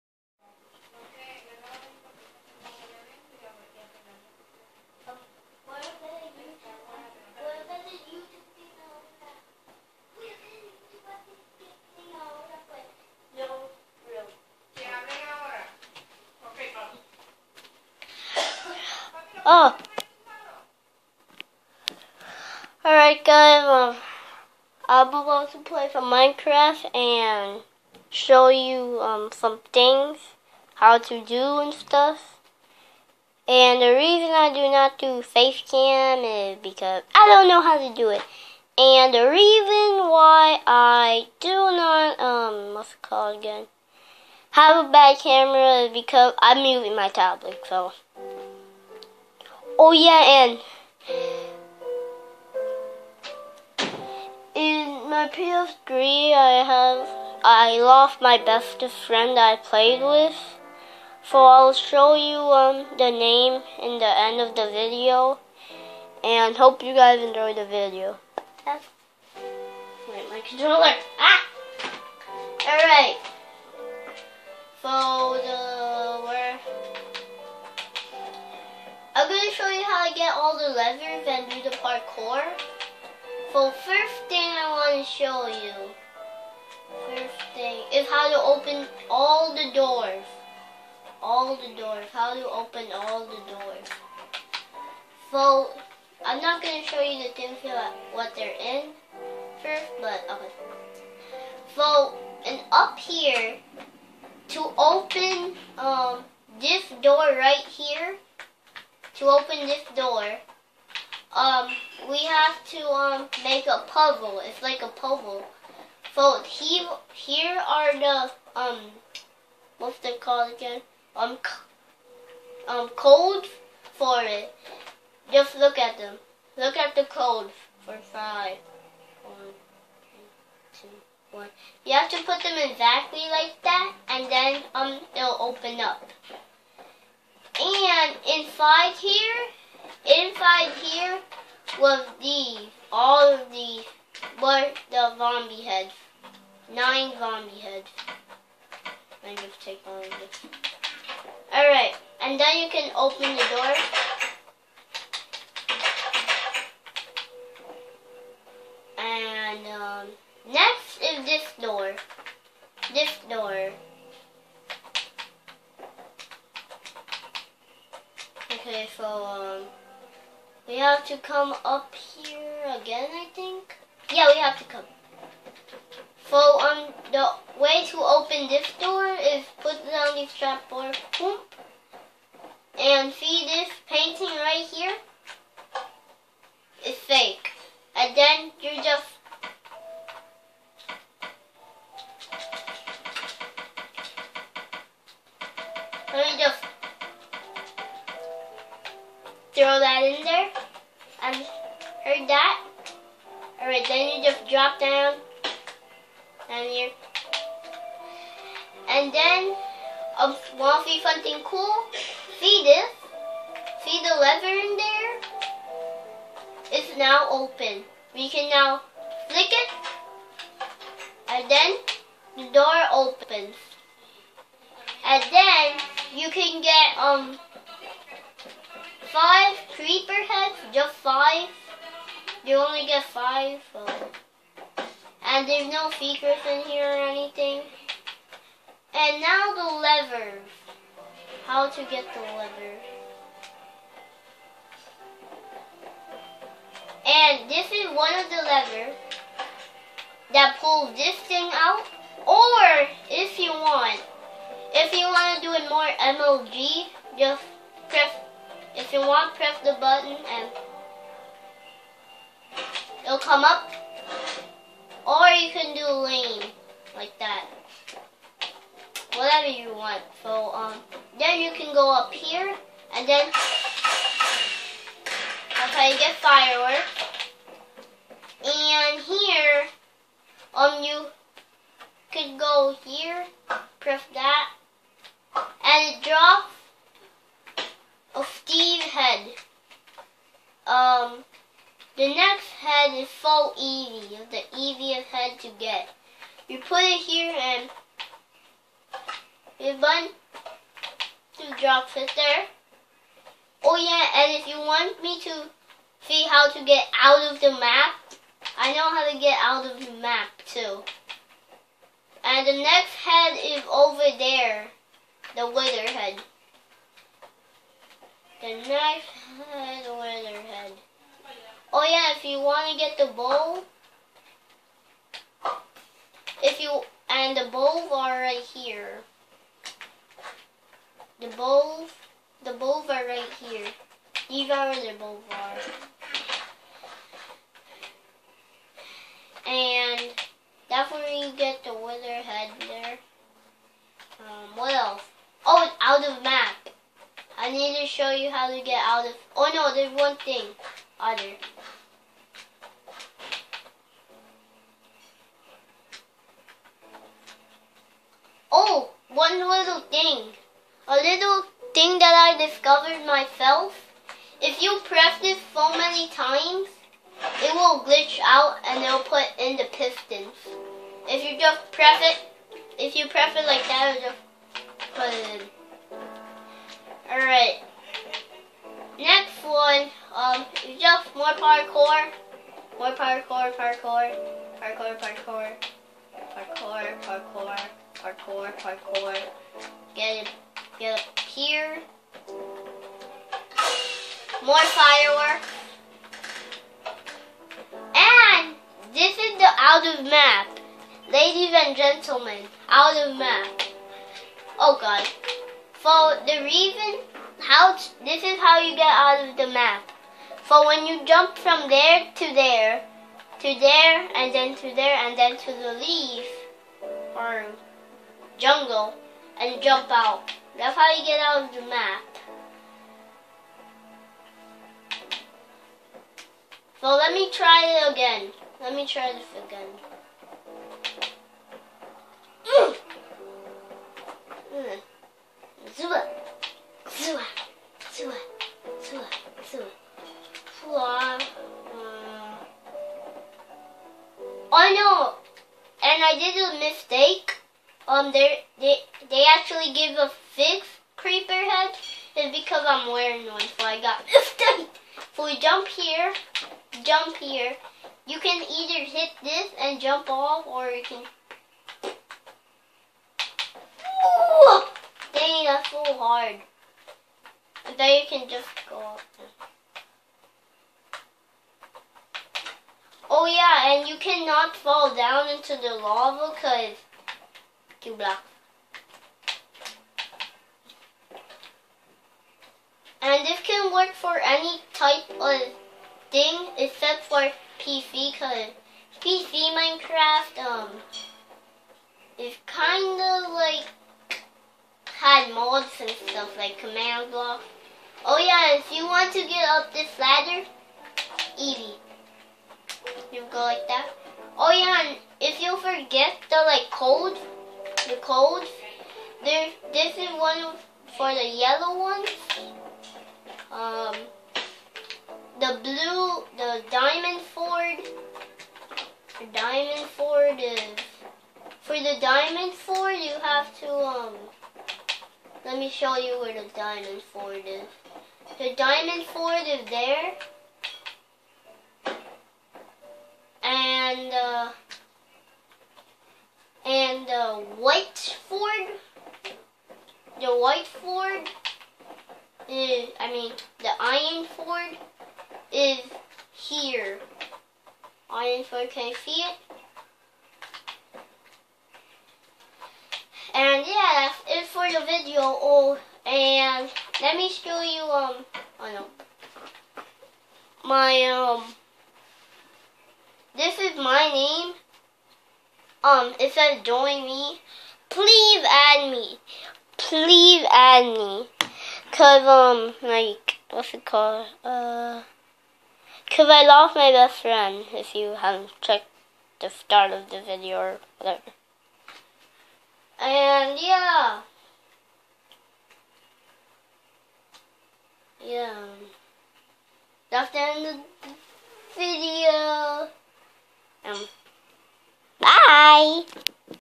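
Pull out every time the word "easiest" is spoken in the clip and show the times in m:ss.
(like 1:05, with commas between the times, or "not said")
4:54.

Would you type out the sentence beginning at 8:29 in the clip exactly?
There, this is one for the yellow ones.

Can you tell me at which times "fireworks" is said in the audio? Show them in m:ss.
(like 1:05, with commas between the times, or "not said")
4:36, 6:34.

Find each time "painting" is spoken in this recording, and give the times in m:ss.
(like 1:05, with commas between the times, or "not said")
3:03.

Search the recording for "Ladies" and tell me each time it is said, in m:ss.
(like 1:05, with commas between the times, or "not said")
6:41.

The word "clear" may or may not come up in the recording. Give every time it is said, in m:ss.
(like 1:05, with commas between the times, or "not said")
not said.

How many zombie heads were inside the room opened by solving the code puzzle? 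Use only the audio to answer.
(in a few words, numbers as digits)
9.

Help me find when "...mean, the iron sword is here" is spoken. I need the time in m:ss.
9:03.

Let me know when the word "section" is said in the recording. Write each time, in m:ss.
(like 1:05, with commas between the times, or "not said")
not said.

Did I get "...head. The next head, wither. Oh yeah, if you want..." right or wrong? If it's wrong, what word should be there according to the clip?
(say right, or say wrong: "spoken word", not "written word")
right.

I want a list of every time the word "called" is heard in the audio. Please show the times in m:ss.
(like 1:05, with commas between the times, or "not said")
0:43, 2:00, 9:33.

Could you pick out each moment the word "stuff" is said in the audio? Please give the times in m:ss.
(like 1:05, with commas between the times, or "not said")
0:31, 8:15.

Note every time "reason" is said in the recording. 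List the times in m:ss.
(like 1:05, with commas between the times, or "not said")
0:33, 0:39, 6:46.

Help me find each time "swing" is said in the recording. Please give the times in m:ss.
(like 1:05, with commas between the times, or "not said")
not said.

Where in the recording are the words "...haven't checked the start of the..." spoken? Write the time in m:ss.
9:38.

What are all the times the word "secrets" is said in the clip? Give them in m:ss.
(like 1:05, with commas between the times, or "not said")
3:55.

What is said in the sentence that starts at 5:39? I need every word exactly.
And that's where you get the wither head there.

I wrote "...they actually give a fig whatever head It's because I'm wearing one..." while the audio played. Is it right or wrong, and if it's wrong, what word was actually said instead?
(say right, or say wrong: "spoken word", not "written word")
wrong: "creeper", not "whatever".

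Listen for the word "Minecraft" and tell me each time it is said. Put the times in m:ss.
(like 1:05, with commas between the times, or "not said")
0:26, 8:09.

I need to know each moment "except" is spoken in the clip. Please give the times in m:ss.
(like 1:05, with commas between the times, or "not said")
8:06.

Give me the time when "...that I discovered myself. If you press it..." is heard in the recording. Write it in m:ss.
6:01.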